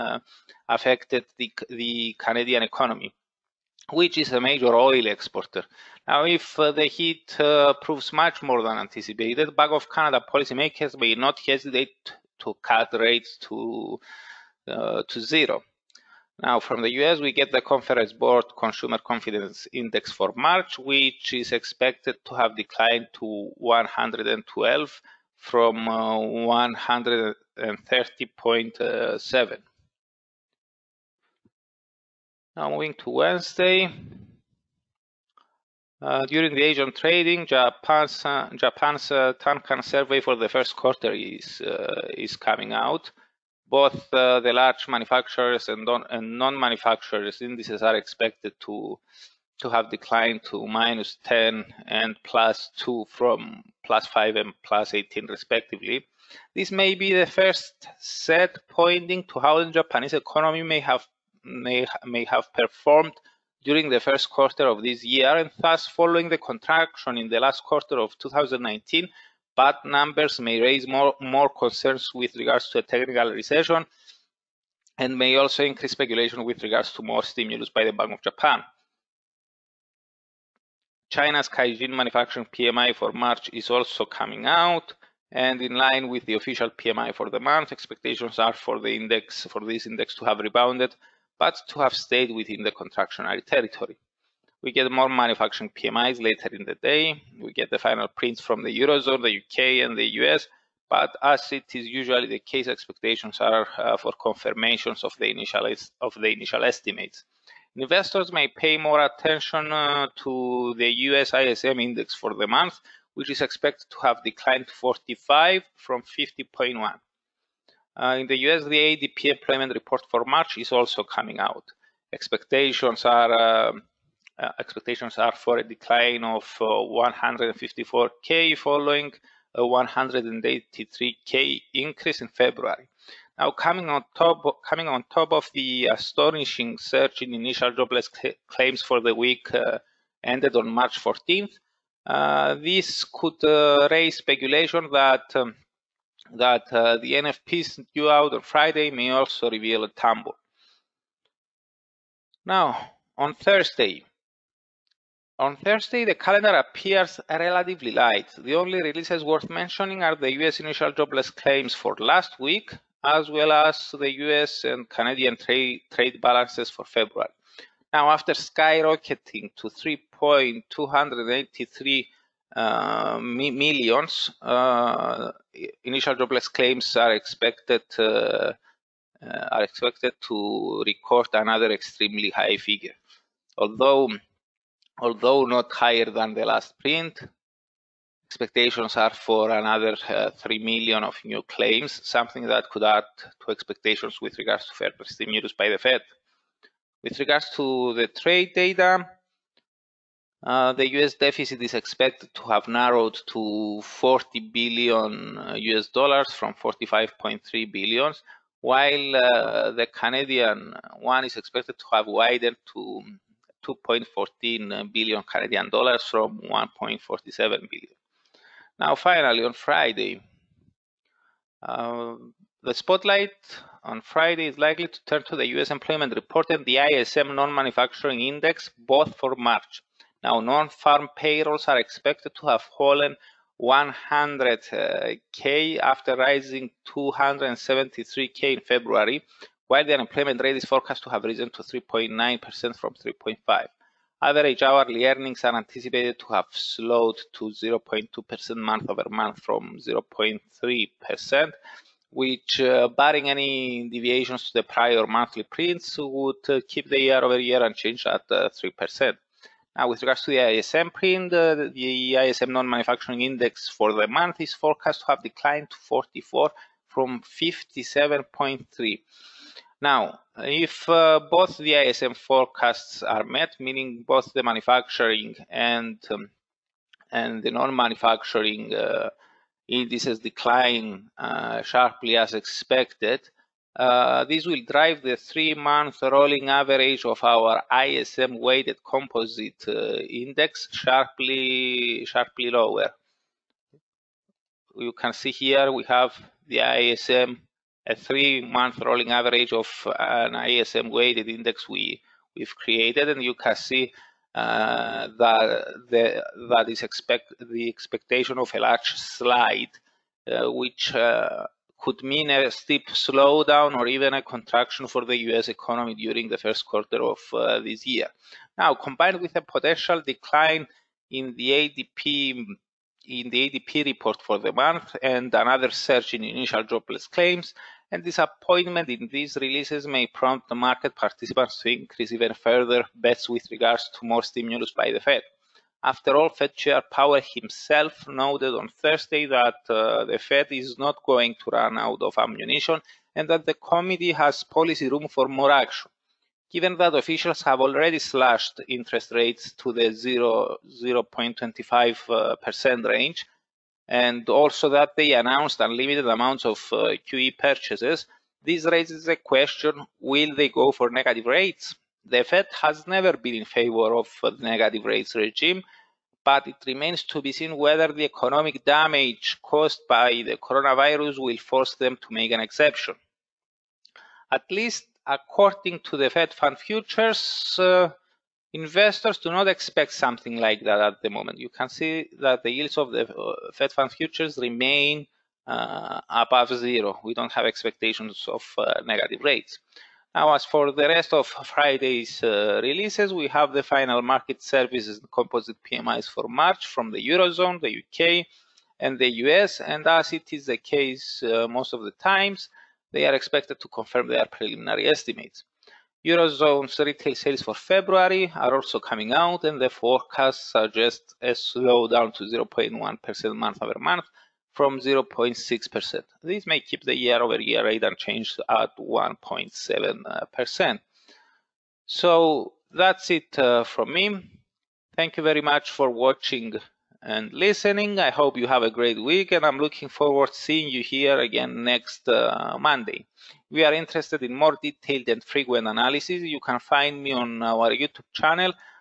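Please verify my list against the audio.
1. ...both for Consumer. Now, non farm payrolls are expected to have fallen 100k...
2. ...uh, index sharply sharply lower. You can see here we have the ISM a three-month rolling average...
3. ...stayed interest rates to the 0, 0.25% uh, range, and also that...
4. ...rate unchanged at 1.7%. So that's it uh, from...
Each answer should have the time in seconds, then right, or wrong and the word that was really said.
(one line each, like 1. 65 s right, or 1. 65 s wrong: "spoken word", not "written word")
1. 228 s wrong: "March", not "Consumer"
2. 289 s right
3. 347 s wrong: "slashed", not "stayed"
4. 417 s right.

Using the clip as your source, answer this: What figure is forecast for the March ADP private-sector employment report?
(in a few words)
154k.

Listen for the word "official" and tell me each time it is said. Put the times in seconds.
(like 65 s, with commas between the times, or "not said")
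86 s, 346 s.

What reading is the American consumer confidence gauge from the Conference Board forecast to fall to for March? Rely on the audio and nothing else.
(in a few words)
112.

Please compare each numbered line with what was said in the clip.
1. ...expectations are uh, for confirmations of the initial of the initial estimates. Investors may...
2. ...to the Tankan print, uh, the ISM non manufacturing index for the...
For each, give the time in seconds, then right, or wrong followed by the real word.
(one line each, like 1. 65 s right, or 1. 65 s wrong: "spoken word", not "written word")
1. 102 s right
2. 260 s wrong: "ISM", not "Tankan".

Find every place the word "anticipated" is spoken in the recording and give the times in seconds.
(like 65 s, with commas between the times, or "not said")
8 s, 245 s.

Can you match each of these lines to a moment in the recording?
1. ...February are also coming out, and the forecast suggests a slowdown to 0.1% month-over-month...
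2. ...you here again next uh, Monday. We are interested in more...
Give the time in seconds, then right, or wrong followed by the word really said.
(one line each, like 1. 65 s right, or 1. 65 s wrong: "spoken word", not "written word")
1. 407 s right
2. 430 s right.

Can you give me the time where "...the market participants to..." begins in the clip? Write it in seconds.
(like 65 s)
330 s.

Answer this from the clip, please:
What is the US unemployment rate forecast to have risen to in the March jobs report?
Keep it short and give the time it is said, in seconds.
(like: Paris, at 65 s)
3.9%, at 241 s.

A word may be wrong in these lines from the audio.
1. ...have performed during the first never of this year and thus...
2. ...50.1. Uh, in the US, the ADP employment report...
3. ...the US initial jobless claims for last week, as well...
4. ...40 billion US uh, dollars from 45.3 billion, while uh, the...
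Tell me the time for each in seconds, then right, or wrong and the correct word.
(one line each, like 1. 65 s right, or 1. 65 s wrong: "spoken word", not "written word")
1. 62 s wrong: "quarter", not "never"
2. 116 s right
3. 160 s right
4. 203 s right.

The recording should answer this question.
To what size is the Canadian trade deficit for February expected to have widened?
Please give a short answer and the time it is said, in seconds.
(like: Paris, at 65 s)
2.14 billion Canadian dollars, at 213 s.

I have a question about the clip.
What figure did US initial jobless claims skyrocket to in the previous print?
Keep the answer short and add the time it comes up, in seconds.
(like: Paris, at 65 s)
3.283 million, at 169 s.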